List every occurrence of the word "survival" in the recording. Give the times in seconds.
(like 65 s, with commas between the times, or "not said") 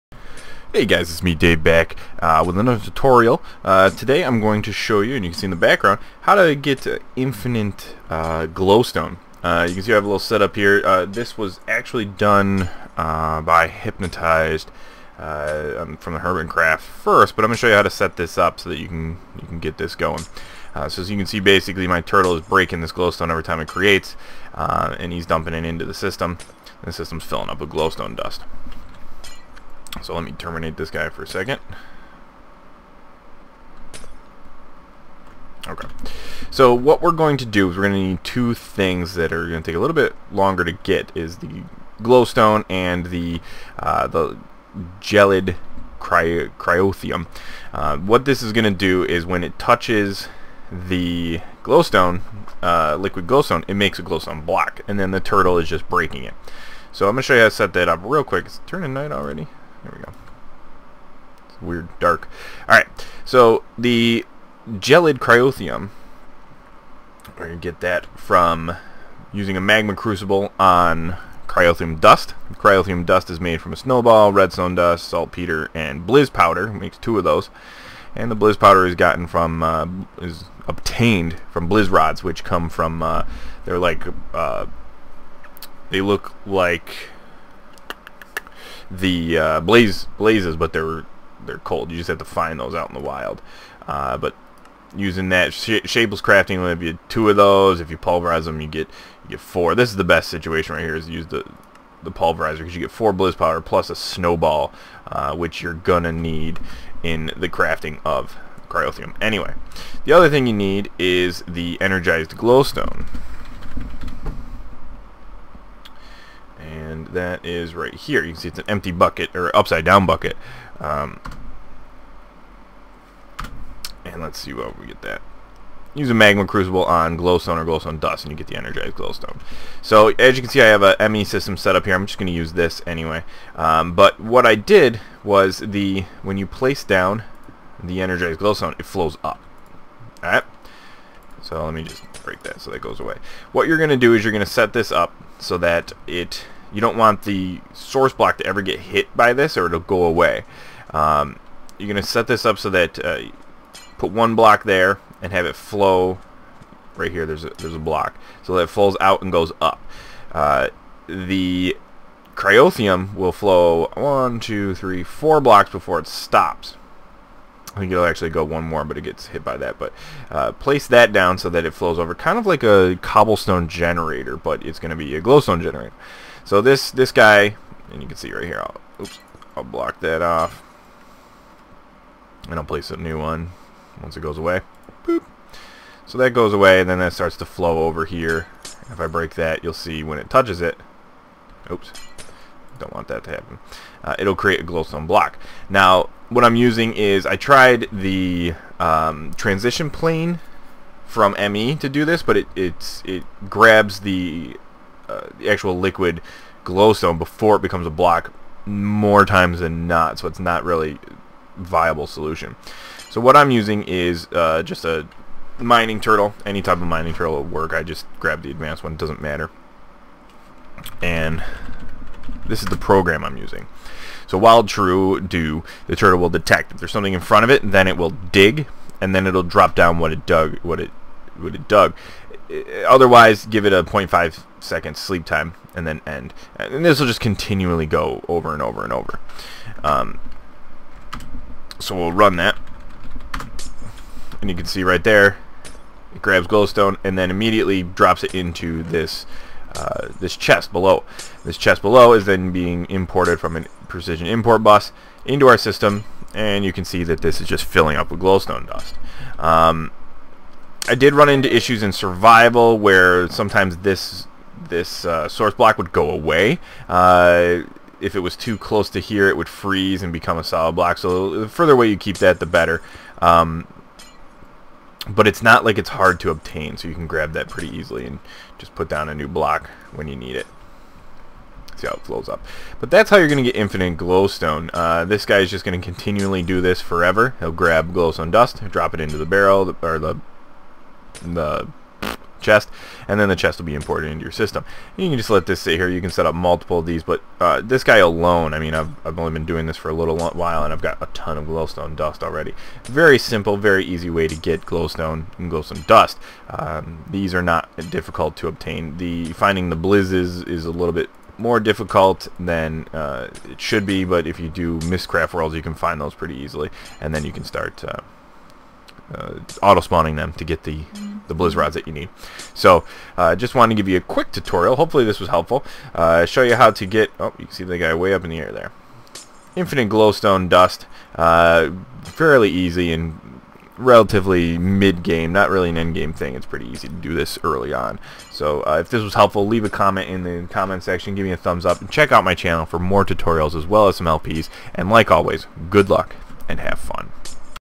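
261 s.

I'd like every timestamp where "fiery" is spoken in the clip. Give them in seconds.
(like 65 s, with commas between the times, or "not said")
not said.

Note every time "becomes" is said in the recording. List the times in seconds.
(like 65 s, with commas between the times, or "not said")
207 s, 270 s.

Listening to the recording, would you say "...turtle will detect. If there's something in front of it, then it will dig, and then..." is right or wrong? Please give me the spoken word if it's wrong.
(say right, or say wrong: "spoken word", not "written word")
right.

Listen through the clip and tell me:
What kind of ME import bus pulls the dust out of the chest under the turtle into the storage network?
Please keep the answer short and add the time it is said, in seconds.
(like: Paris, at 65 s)
precision import bus, at 253 s.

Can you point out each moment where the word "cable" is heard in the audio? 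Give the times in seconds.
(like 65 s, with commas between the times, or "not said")
not said.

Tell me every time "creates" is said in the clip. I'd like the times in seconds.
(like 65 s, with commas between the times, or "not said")
23 s, 194 s.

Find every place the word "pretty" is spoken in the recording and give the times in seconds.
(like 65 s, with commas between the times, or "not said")
277 s, 316 s, 336 s.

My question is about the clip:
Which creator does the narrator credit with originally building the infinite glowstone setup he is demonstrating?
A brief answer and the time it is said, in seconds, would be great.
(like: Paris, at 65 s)
Hypnotizd, at 13 s.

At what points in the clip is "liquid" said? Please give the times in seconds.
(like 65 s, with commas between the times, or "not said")
52 s, 205 s.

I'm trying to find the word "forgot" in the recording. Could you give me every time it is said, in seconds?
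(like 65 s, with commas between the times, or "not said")
not said.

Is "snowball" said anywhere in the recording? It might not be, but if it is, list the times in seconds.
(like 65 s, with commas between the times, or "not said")
73 s, 103 s.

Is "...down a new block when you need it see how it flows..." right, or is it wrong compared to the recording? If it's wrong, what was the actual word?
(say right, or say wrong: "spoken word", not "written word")
right.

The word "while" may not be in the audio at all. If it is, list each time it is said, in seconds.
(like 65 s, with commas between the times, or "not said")
224 s, 300 s.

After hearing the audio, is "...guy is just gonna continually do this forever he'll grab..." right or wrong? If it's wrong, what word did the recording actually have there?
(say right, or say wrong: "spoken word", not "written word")
right.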